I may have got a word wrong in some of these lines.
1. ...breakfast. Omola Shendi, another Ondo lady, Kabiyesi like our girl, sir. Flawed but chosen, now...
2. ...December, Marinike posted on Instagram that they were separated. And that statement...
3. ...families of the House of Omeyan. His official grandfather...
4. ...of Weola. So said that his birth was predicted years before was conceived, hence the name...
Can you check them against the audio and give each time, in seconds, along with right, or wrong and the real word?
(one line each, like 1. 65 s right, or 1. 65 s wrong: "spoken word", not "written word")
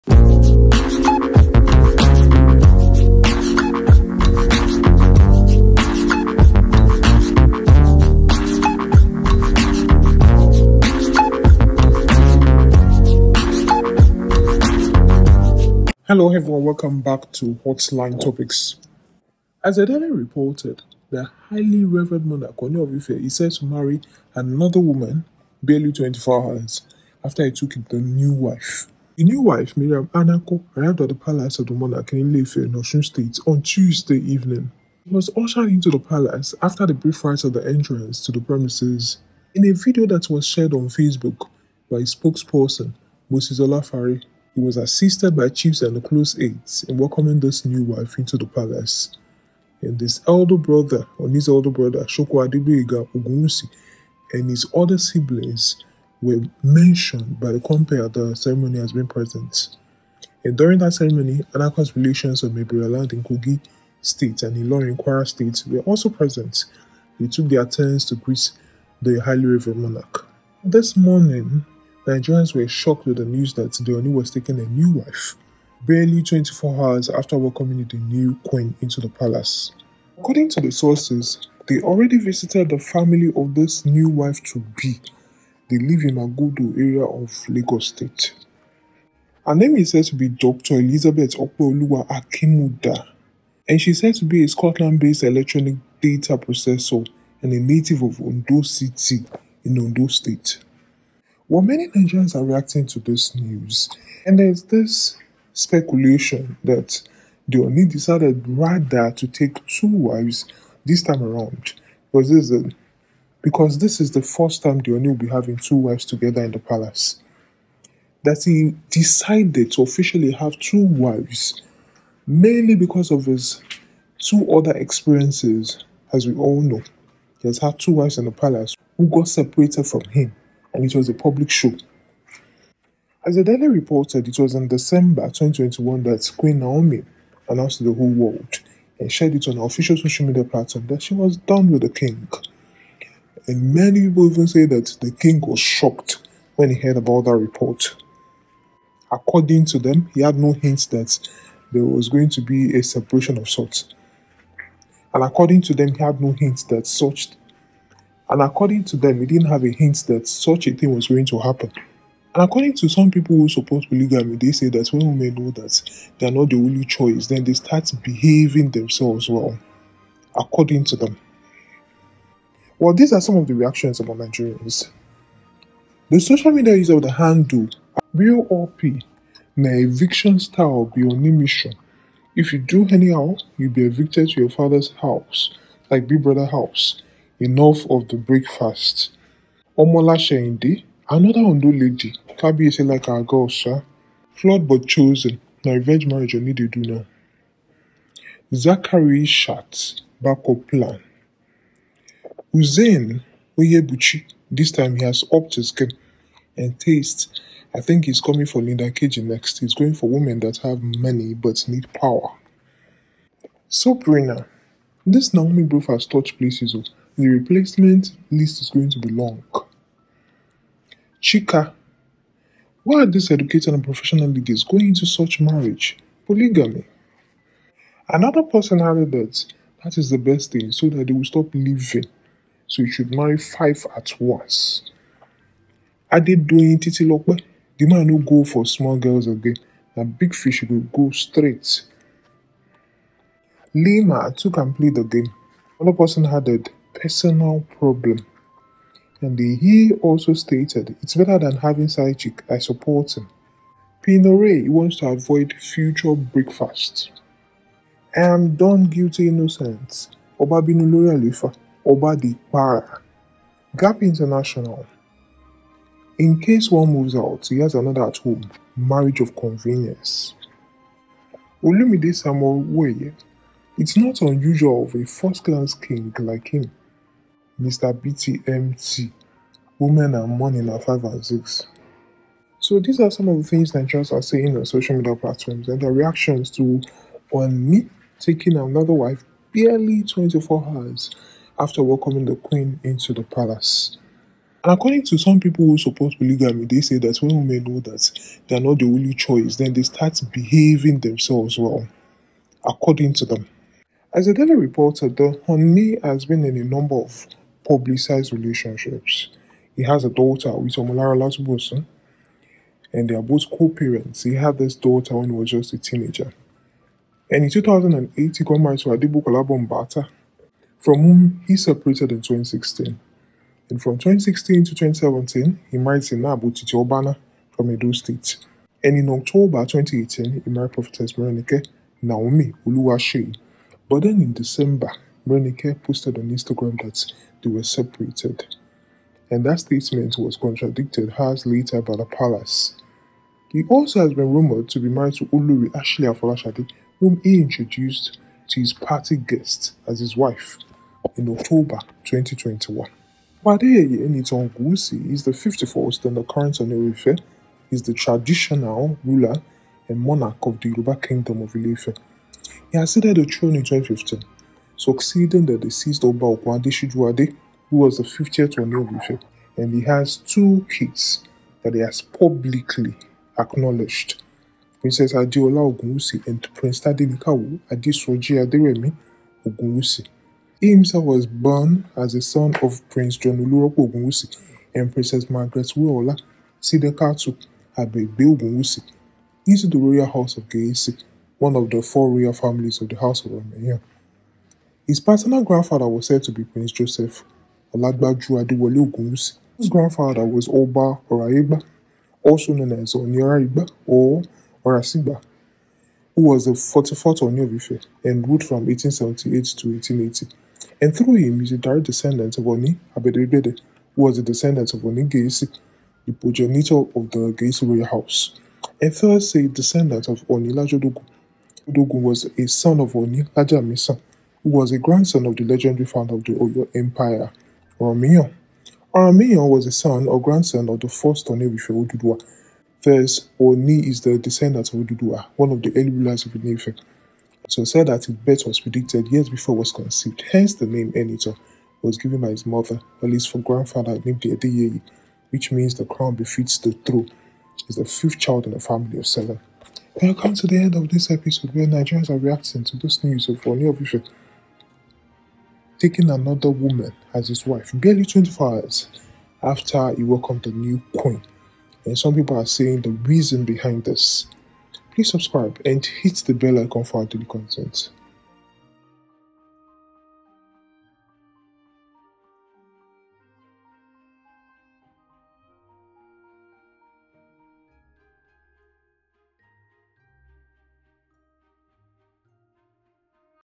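1. 188 s right
2. 334 s right
3. 392 s wrong: "paternal", not "official"
4. 436 s wrong: "Onewife", not "Weola".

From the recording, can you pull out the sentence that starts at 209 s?
He's going for women that have money but need power.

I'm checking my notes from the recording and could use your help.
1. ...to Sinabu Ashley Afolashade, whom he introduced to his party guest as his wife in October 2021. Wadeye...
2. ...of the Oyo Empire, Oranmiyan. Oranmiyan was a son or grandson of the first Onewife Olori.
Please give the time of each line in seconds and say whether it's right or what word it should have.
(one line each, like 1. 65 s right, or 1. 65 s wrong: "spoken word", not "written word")
1. 345 s wrong: "Olori", not "Sinabu"
2. 426 s wrong: "Oduduwa", not "Olori".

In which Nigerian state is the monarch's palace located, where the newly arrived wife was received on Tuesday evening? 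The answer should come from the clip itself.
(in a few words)
Osun State.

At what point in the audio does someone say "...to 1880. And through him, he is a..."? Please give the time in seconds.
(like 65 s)
409 s.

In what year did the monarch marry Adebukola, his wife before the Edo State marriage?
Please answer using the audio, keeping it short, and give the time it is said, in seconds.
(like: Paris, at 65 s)
2008, at 317 s.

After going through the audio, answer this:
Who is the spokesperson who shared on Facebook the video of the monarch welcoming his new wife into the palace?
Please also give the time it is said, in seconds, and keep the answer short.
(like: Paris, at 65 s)
Moses Olafare, at 43 s.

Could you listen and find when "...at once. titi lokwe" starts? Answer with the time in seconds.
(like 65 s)
233 s.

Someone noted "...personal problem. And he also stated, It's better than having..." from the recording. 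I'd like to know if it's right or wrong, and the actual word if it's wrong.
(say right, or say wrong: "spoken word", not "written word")
right.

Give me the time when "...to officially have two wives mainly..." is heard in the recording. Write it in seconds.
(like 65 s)
119 s.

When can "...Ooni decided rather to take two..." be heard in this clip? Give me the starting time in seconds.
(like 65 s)
107 s.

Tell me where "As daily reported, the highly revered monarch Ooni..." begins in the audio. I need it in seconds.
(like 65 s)
19 s.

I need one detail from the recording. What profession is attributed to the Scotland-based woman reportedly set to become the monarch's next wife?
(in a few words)
Electronic data processor.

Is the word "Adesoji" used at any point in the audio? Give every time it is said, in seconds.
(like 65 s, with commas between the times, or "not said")
377 s.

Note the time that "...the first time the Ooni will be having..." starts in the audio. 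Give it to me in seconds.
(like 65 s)
114 s.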